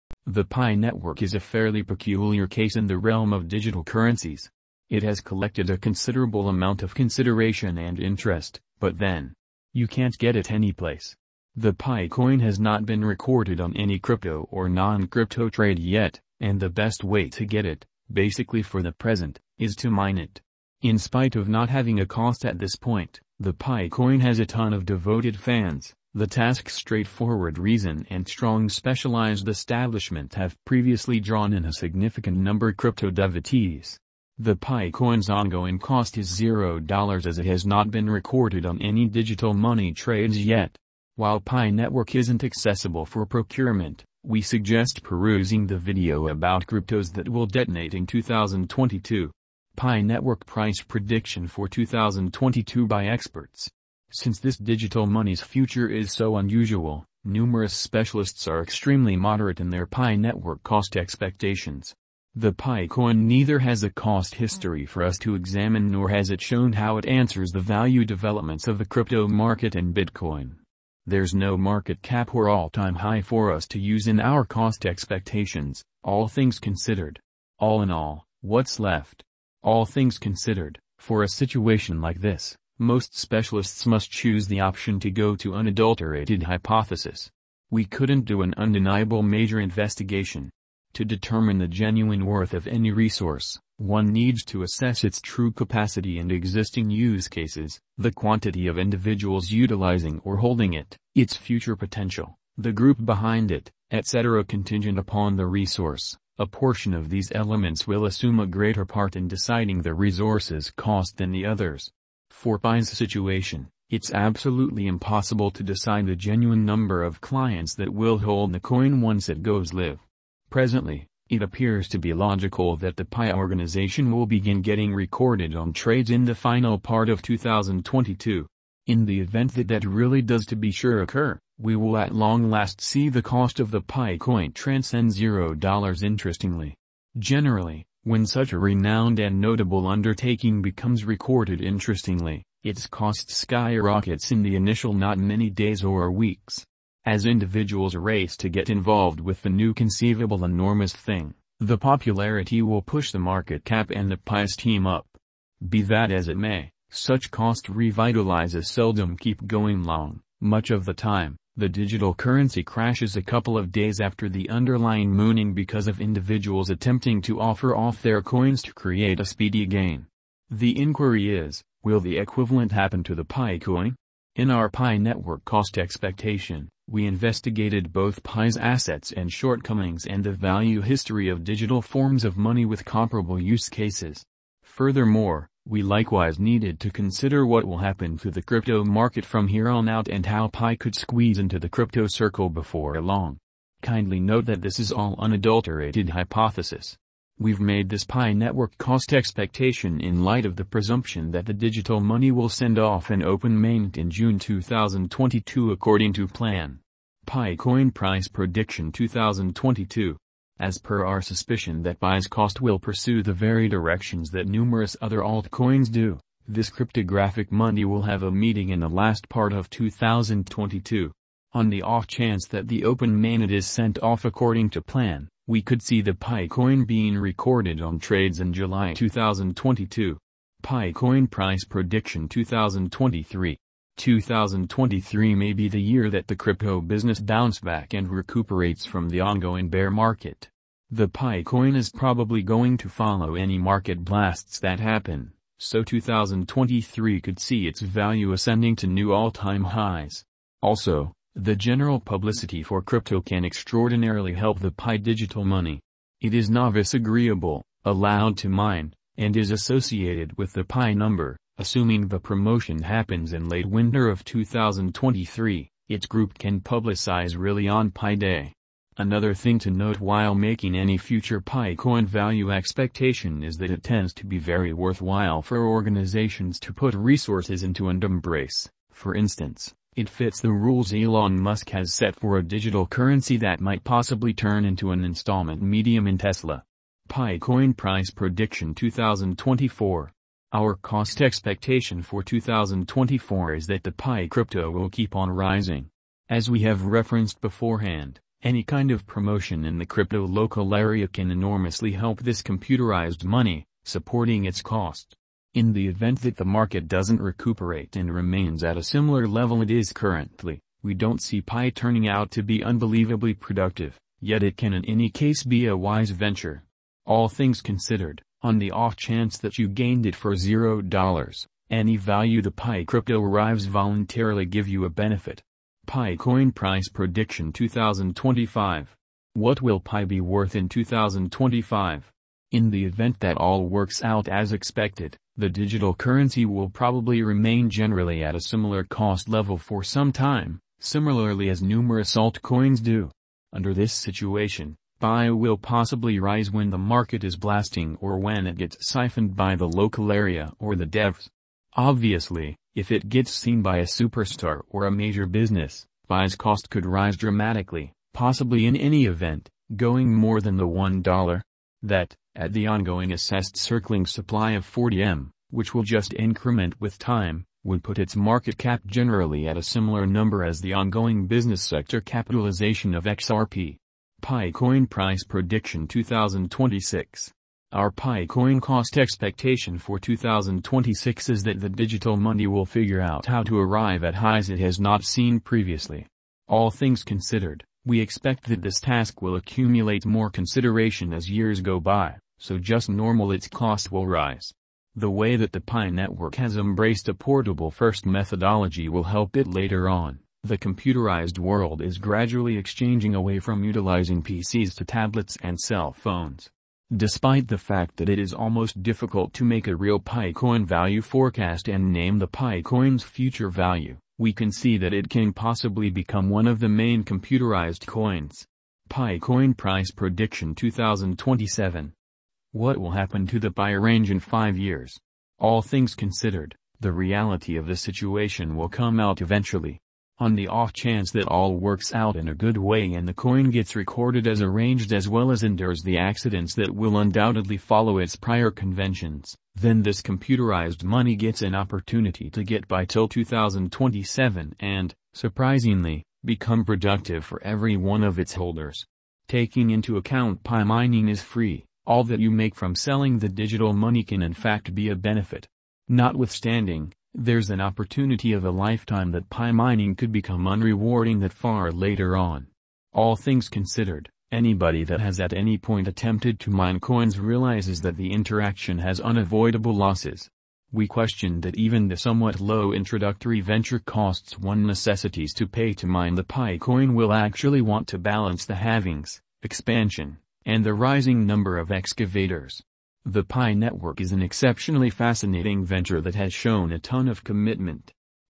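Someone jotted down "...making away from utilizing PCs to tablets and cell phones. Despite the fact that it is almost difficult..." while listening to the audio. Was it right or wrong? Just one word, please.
wrong.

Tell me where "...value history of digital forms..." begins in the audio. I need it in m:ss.
3:00.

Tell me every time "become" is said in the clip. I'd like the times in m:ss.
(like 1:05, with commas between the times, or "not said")
2:20, 6:55, 7:26, 7:40.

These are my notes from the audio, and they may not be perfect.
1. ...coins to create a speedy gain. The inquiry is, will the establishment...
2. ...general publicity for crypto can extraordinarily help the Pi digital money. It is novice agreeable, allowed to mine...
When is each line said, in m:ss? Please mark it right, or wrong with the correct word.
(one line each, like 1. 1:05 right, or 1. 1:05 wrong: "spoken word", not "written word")
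1. 2:48 wrong: "equivalent", not "establishment"
2. 4:11 right.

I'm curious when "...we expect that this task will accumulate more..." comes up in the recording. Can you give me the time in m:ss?
6:27.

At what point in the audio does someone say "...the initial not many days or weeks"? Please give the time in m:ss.
2:24.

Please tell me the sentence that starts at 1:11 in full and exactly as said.
There's no market cap or all-time high for us to use in our cost expectations, all things considered.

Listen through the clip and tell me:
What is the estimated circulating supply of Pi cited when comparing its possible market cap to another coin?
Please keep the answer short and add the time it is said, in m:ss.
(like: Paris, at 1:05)
40M, at 6:04.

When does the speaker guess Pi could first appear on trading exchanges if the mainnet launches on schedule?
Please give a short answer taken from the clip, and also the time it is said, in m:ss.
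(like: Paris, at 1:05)
July 2022, at 3:48.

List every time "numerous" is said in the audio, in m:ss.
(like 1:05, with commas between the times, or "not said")
0:57, 3:34, 5:41.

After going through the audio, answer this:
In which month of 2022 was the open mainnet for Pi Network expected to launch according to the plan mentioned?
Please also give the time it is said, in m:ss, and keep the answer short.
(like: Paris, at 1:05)
June, at 3:24.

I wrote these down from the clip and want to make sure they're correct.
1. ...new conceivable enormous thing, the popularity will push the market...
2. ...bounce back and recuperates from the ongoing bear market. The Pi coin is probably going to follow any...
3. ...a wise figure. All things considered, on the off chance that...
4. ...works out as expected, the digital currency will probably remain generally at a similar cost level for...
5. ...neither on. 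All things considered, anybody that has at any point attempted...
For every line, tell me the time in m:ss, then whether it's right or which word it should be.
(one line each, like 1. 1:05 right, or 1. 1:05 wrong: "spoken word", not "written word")
1. 2:29 right
2. 3:57 right
3. 5:15 wrong: "venture", not "figure"
4. 5:33 right
5. 7:41 wrong: "later", not "neither".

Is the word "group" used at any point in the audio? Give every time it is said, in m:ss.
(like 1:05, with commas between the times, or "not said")
1:42, 4:26.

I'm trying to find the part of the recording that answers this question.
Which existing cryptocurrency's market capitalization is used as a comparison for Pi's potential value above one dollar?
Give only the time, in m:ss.
6:13.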